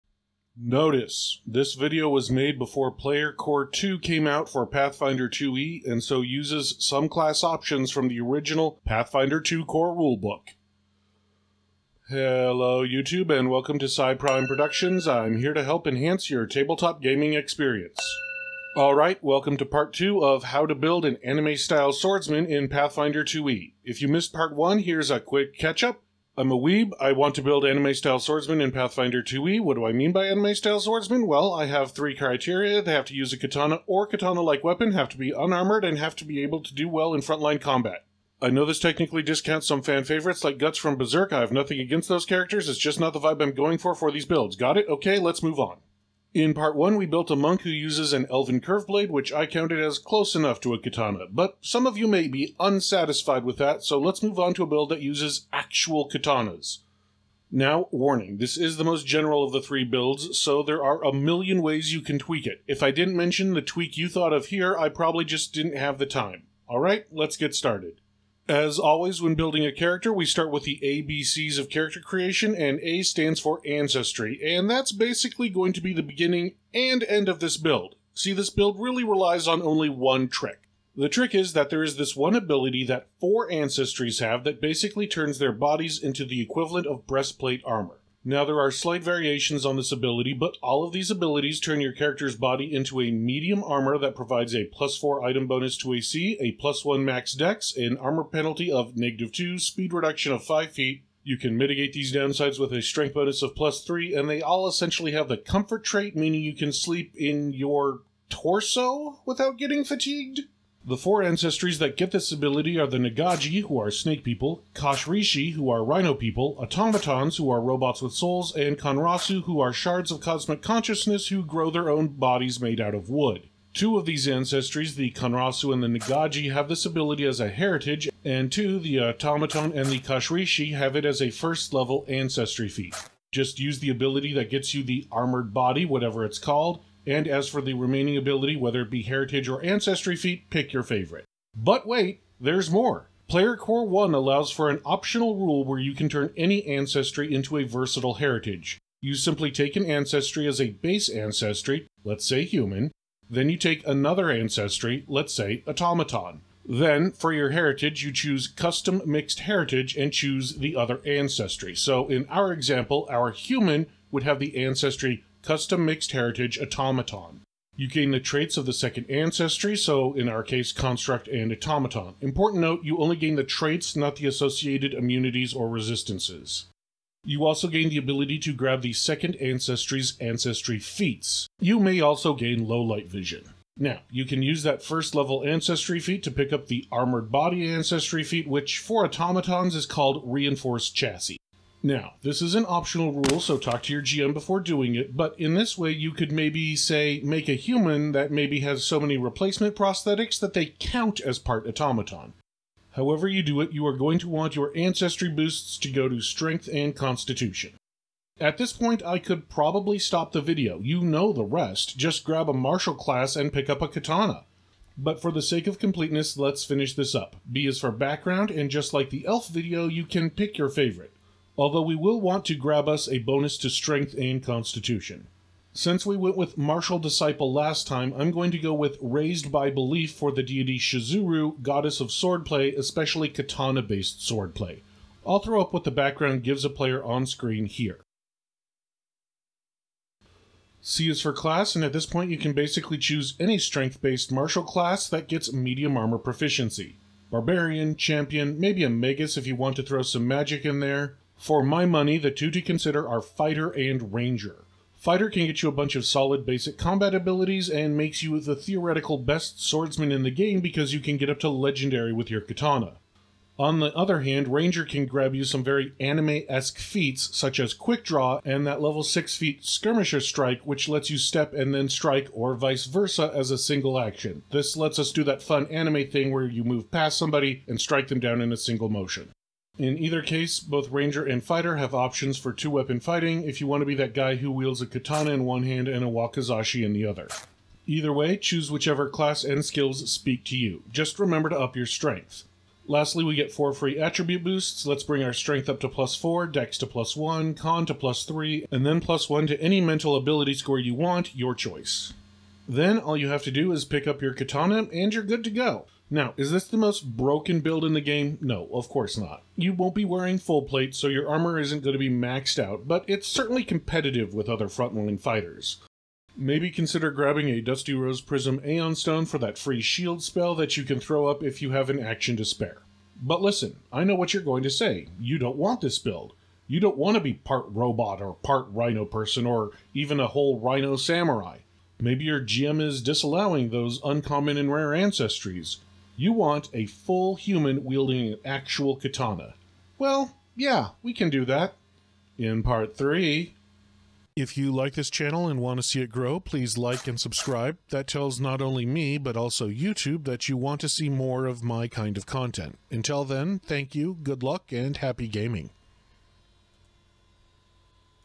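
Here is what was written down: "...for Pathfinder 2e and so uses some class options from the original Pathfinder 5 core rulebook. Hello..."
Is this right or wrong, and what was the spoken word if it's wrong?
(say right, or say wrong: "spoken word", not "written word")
wrong: "2", not "5".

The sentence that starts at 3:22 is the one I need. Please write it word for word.
However, you do it, you are going to want your ancestry boosts to go to strength and constitution.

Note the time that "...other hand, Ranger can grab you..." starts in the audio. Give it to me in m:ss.
4:23.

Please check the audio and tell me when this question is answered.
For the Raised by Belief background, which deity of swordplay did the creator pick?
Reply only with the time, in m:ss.
3:50.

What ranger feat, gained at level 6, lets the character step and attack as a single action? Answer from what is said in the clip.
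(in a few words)
Skirmisher Strike.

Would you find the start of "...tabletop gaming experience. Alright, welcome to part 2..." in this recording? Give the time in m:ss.
0:16.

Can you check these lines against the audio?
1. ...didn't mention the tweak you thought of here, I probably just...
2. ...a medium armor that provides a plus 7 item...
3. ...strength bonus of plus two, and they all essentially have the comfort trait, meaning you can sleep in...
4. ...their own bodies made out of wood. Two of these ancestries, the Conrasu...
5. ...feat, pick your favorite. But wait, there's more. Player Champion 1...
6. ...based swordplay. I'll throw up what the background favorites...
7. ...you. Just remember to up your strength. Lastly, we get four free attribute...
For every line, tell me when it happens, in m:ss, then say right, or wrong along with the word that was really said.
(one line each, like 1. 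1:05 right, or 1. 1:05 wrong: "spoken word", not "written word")
1. 1:02 right
2. 1:33 wrong: "4", not "7"
3. 1:42 wrong: "three", not "two"
4. 2:01 right
5. 2:20 wrong: "Core", not "Champion"
6. 3:53 wrong: "gives", not "favorites"
7. 4:50 right.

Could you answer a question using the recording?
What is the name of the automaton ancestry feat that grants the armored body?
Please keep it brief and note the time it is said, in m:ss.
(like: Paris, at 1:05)
Reinforced Chassis, at 3:10.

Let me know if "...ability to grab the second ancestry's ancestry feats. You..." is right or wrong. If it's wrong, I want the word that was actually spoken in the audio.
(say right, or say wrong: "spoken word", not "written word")
right.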